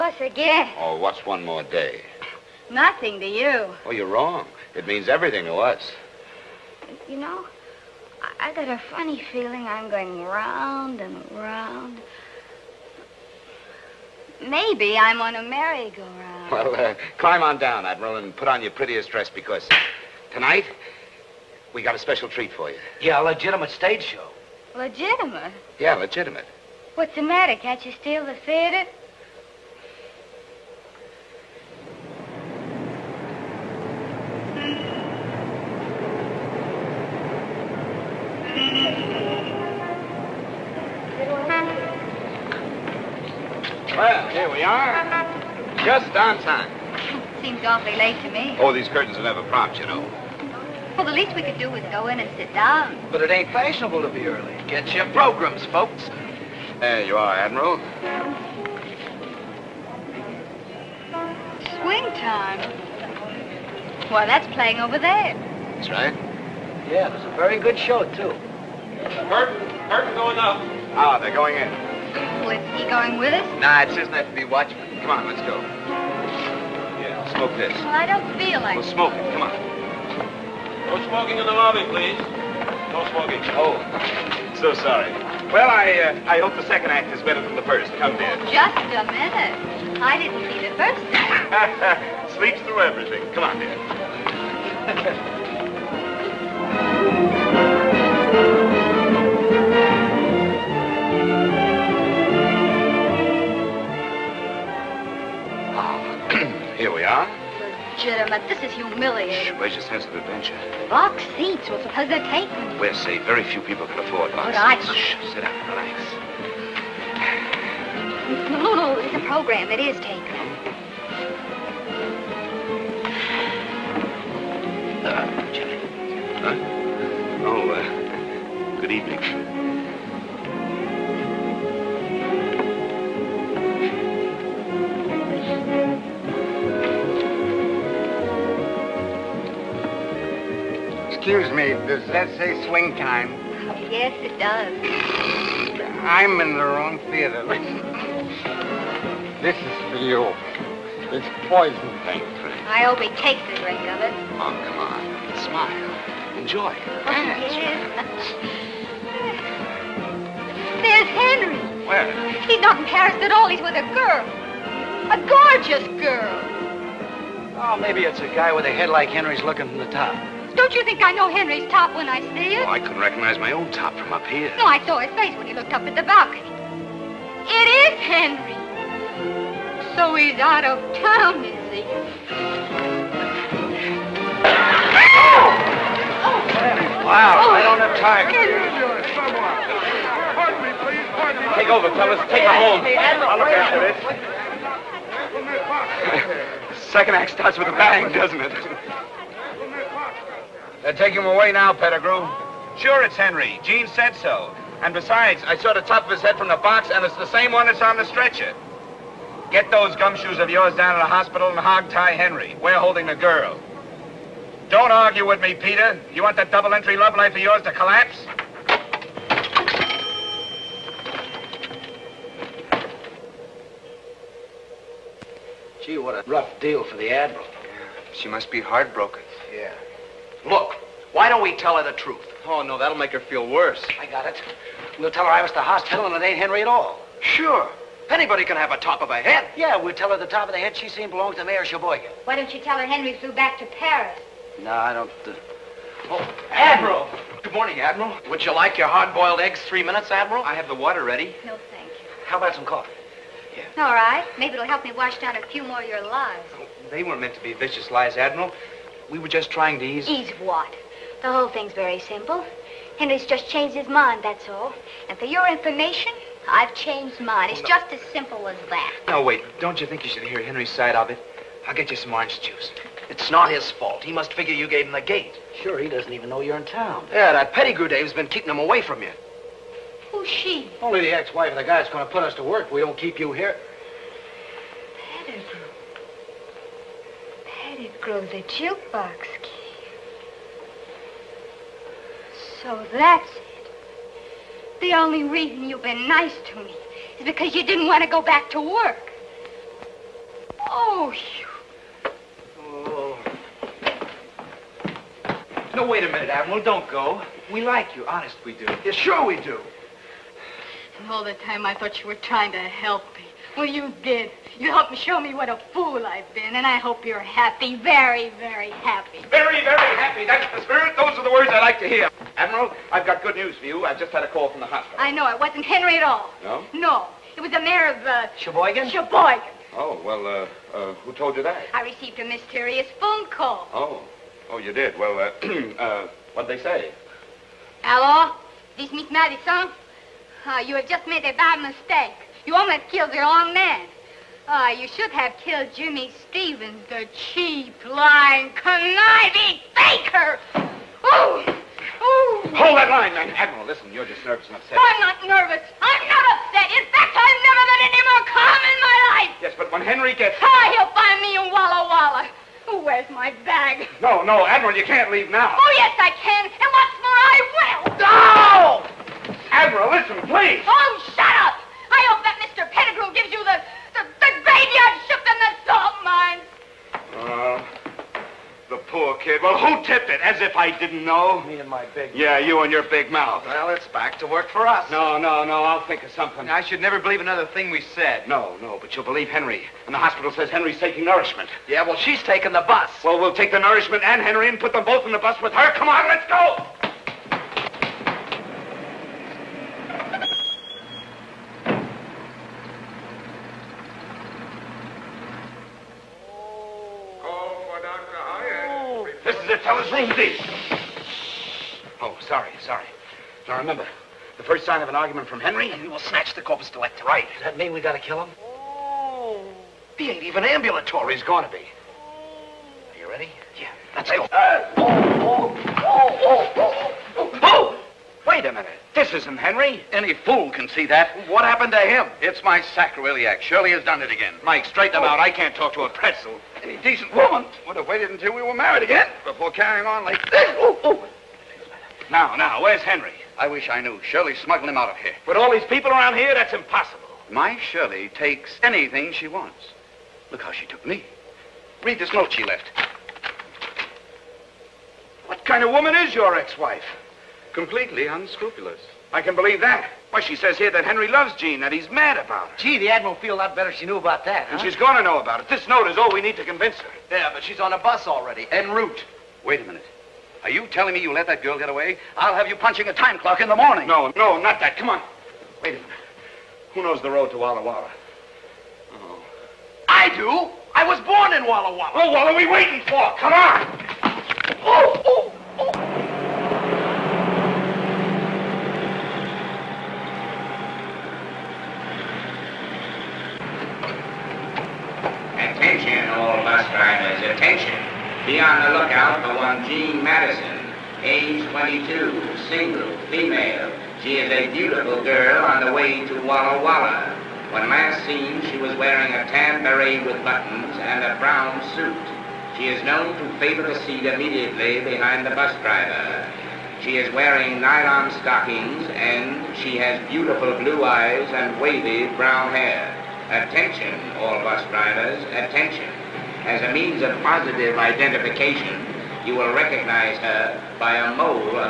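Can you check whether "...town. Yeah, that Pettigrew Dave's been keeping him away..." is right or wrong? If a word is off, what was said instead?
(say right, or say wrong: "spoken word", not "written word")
right.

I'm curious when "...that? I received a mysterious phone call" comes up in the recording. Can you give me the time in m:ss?
5:31.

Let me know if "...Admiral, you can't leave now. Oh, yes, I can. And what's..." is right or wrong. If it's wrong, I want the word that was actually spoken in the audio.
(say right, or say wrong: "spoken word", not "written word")
right.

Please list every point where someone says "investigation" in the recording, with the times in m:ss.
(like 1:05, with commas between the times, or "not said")
not said.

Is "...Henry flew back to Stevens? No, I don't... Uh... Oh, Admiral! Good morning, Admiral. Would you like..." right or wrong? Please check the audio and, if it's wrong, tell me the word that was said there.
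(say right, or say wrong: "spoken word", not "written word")
wrong: "Paris", not "Stevens".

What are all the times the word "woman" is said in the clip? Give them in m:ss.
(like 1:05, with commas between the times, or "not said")
7:17, 7:35.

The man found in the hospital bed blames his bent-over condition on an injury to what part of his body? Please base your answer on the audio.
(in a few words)
Sacroiliac.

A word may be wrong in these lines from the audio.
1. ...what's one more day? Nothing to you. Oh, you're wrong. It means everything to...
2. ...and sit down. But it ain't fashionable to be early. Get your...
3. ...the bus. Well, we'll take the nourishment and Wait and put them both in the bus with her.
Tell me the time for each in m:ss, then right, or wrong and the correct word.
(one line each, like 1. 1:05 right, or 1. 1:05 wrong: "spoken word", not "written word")
1. 0:00 right
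2. 0:52 right
3. 6:32 wrong: "Henry", not "Wait".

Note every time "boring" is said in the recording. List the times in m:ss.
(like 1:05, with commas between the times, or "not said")
not said.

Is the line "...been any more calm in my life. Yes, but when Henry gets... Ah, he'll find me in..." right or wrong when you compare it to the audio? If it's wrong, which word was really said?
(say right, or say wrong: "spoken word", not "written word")
right.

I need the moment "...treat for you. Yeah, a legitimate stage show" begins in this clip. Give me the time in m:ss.
0:22.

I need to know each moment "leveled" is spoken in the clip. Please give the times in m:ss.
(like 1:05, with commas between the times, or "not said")
not said.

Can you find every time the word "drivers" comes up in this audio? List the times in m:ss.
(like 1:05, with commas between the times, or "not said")
8:16, 8:35, 8:44.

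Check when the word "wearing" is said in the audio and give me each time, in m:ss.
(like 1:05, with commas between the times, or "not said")
8:28, 8:37.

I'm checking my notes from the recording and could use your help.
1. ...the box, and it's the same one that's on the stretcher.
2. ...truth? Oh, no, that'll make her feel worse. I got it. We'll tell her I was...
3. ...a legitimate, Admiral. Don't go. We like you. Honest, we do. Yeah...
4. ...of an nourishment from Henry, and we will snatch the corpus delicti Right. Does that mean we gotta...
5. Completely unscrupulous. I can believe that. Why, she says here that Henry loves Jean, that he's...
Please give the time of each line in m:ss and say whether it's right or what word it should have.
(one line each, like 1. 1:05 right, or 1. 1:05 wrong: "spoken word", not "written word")
1. 3:26 right
2. 3:51 right
3. 5:06 wrong: "minute", not "legitimate"
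4. 6:54 wrong: "argument", not "nourishment"
5. 7:37 right.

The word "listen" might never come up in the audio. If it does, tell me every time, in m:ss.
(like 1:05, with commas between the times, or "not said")
5:53, 6:09.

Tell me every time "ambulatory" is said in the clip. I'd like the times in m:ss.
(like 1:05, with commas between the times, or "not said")
7:00.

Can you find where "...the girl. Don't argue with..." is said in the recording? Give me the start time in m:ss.
3:33.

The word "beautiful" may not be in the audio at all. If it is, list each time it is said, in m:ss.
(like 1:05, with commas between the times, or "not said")
8:24, 8:40.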